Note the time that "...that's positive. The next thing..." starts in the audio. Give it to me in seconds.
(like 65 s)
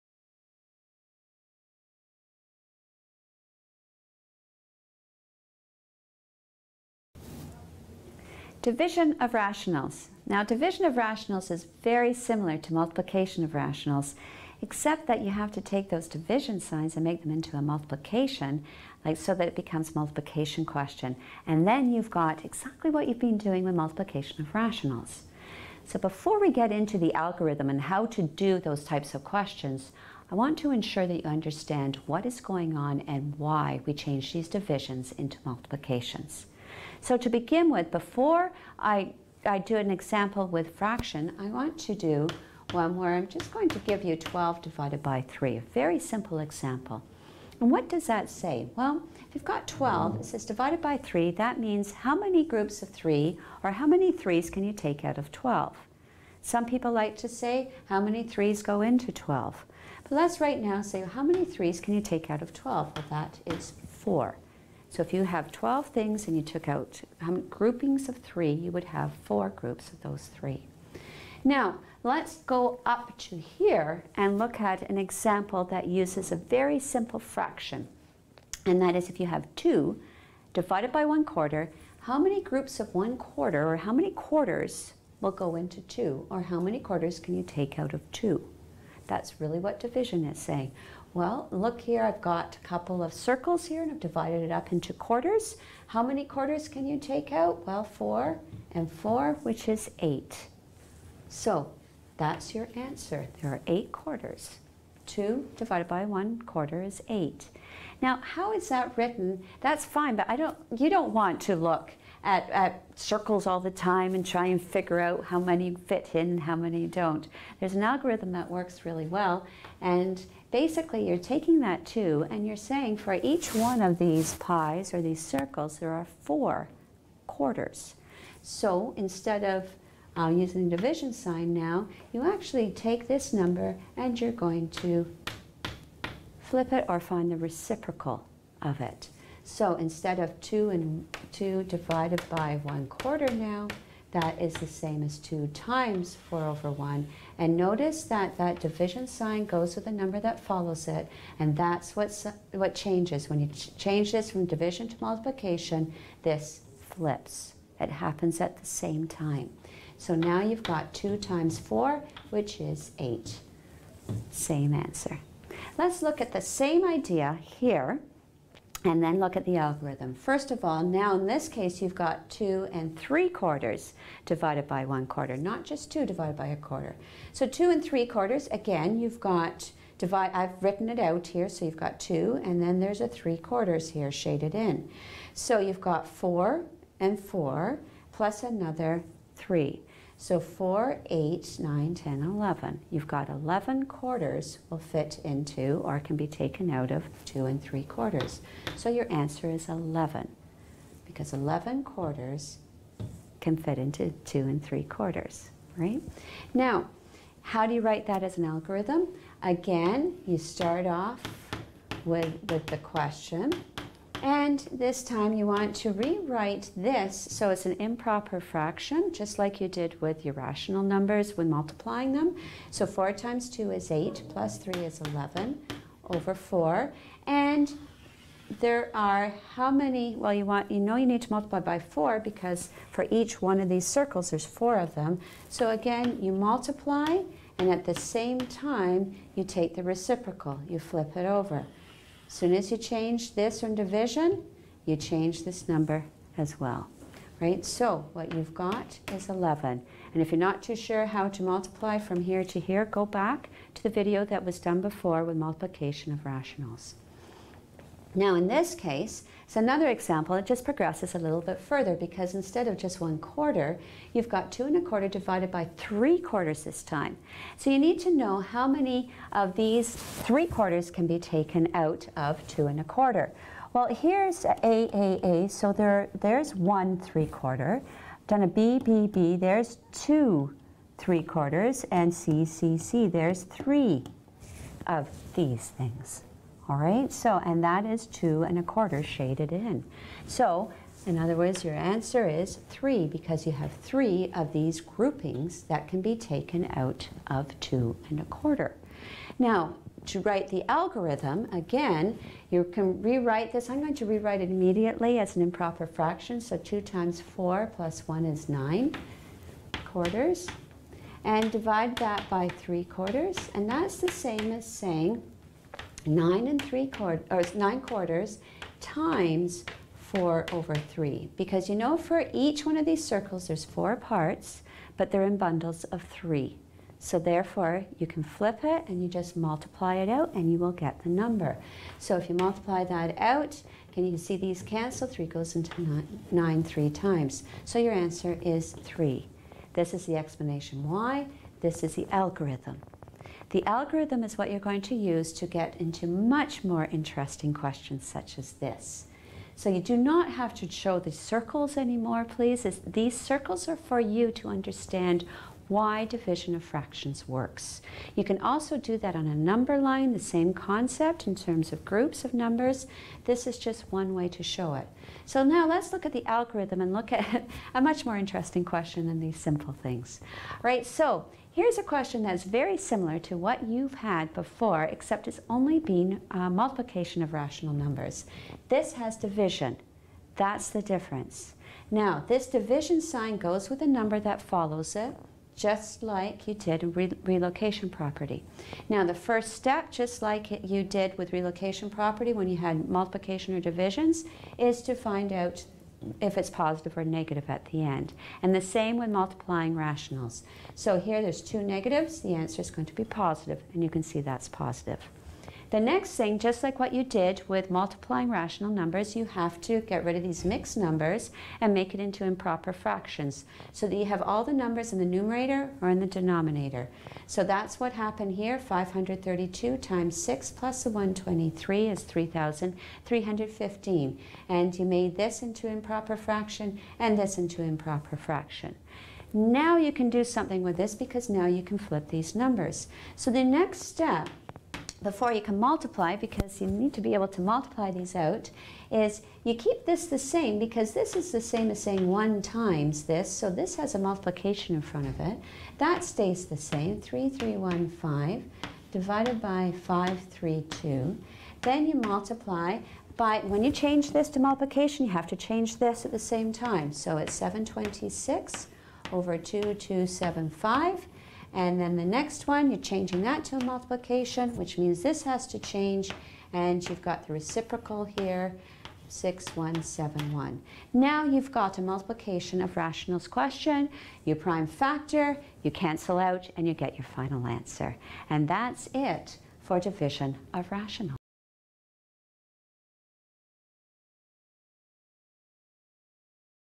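404 s.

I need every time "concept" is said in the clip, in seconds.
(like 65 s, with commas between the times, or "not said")
360 s.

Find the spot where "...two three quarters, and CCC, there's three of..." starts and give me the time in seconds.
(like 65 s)
279 s.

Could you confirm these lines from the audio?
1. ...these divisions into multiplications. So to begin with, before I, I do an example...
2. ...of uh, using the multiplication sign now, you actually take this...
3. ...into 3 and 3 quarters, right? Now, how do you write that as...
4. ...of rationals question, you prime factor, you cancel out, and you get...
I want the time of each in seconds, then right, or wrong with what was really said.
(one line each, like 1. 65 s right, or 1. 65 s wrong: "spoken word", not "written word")
1. 34 s right
2. 129 s wrong: "division", not "multiplication"
3. 203 s wrong: "2", not "3"
4. 472 s right.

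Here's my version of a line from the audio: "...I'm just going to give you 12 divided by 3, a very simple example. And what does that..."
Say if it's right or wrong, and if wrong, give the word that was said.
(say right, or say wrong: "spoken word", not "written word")
right.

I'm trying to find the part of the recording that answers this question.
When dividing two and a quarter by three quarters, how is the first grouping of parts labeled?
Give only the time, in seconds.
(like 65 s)
274 s.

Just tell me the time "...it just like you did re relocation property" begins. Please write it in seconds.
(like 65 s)
384 s.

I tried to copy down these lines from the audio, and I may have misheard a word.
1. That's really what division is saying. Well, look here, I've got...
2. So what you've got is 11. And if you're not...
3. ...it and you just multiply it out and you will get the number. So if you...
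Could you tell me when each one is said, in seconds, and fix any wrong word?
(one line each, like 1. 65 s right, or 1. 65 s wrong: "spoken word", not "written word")
1. 89 s right
2. 247 s right
3. 328 s right.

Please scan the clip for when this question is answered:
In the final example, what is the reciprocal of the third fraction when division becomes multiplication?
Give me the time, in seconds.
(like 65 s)
469 s.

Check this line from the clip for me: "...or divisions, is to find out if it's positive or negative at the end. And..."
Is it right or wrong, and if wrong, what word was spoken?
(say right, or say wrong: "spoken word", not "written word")
right.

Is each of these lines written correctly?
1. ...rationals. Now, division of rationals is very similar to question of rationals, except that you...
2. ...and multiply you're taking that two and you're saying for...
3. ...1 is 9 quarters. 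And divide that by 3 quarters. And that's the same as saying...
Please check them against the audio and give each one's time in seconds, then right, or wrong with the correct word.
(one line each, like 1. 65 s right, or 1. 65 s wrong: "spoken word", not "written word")
1. 9 s wrong: "multiplication", not "question"
2. 119 s wrong: "basically", not "multiply"
3. 308 s right.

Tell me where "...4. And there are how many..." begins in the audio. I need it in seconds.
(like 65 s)
226 s.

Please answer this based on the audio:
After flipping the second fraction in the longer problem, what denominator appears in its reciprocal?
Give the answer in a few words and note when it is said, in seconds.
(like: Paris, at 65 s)
2275, at 459 s.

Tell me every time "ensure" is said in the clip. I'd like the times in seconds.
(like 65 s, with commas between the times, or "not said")
30 s.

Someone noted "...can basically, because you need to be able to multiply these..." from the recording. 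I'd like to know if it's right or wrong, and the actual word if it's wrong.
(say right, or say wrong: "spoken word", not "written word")
wrong: "multiply", not "basically".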